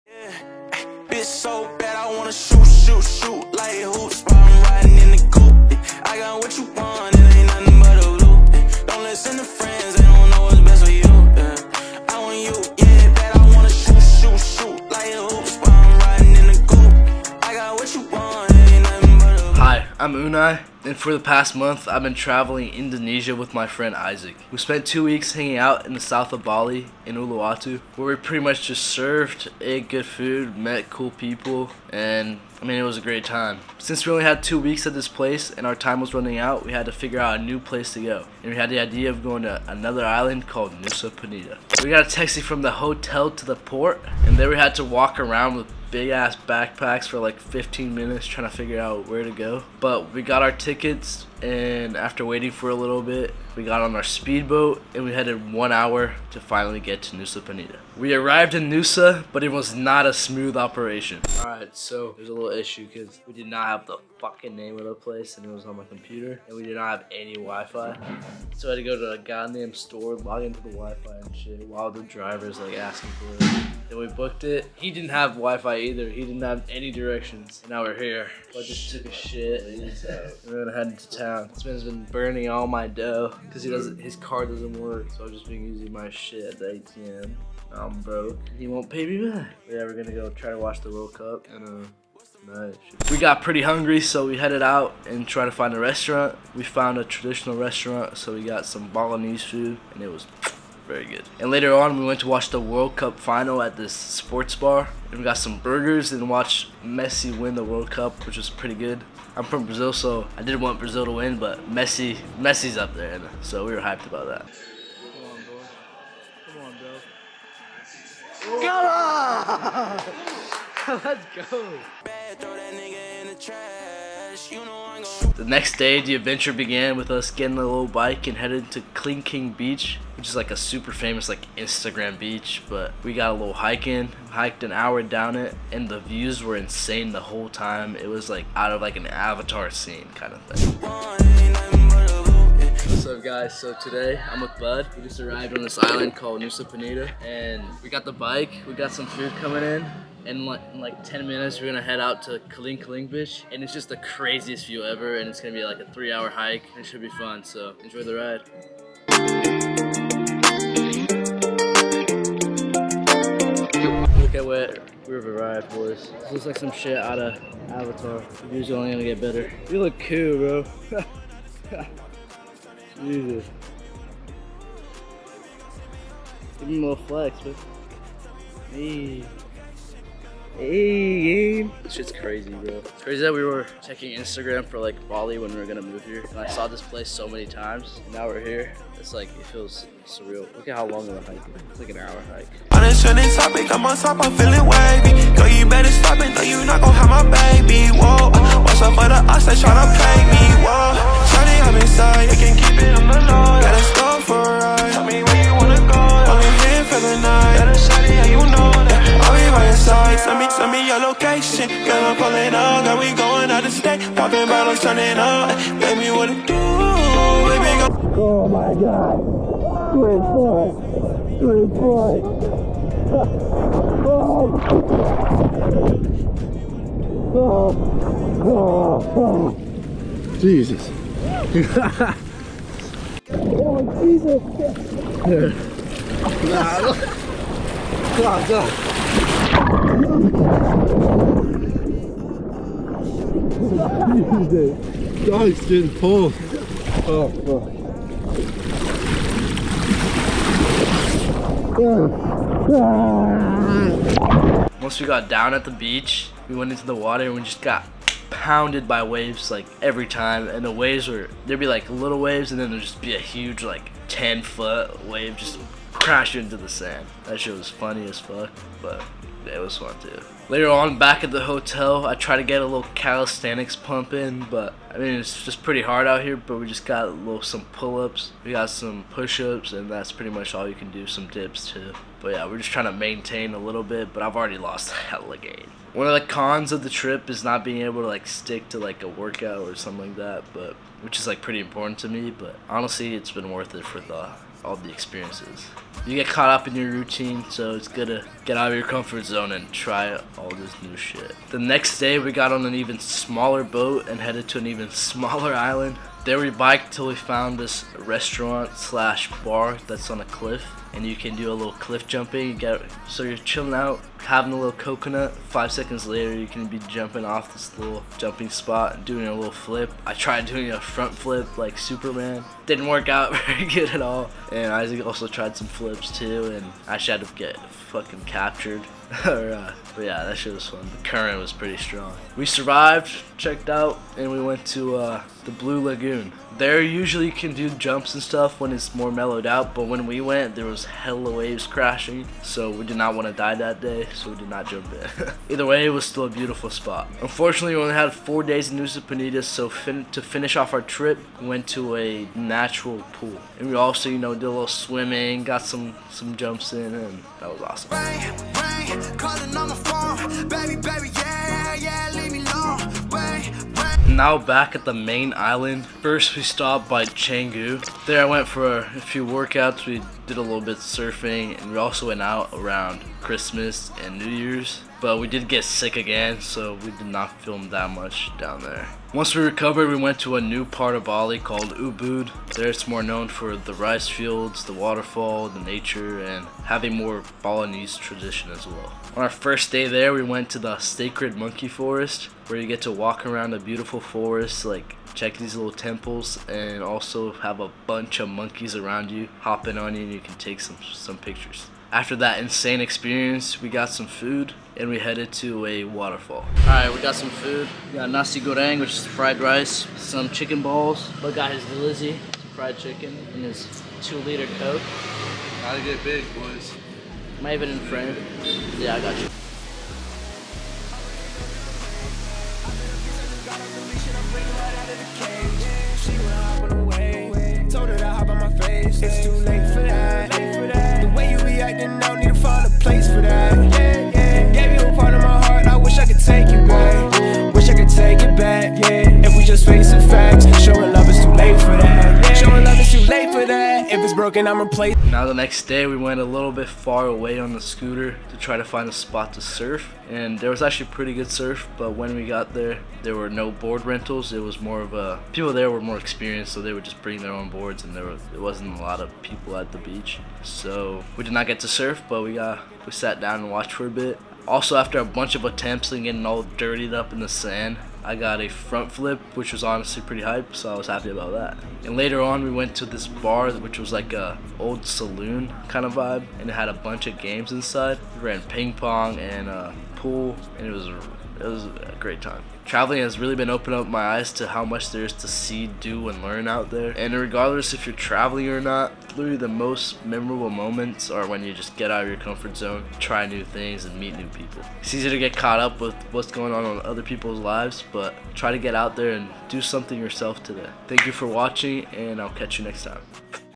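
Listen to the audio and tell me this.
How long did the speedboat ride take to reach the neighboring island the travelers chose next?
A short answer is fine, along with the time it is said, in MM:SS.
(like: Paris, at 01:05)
1 hour, at 00:55.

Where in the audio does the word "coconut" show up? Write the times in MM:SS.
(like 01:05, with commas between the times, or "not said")
05:14.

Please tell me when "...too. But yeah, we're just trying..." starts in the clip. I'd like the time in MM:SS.
04:41.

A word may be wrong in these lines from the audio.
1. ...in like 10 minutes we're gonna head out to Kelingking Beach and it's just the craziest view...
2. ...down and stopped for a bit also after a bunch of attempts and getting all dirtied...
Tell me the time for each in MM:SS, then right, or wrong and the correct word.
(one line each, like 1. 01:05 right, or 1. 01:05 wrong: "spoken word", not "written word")
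1. 02:30 right
2. 07:43 wrong: "watched", not "stopped".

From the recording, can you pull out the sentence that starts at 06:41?
After that insane experience, we got some food and we headed to a waterfall.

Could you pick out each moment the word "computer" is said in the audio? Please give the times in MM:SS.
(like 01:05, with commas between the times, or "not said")
01:05.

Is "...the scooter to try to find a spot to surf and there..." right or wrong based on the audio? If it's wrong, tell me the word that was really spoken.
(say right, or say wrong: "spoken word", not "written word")
right.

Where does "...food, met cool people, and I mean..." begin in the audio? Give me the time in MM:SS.
00:30.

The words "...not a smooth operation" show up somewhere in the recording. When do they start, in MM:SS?
00:59.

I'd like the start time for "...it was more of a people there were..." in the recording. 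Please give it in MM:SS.
07:34.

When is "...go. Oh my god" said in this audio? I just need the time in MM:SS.
03:37.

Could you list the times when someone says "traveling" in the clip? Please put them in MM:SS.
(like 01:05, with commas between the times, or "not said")
00:22, 08:02, 08:07.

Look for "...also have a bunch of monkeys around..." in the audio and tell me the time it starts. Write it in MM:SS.
06:36.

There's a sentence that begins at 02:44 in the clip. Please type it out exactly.
Look at what we've arrived boys.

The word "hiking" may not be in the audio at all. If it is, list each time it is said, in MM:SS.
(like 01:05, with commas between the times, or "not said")
02:13.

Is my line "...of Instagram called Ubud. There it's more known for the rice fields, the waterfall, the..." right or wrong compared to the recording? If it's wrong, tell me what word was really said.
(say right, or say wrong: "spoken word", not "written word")
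wrong: "Bali", not "Instagram".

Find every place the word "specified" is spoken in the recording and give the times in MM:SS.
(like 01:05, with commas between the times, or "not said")
not said.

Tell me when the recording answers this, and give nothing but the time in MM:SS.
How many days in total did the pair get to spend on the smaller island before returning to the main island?
05:48.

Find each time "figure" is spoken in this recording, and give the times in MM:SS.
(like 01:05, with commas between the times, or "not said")
00:36, 00:48.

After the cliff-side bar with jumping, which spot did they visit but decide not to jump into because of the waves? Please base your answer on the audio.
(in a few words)
Blue Lagoon.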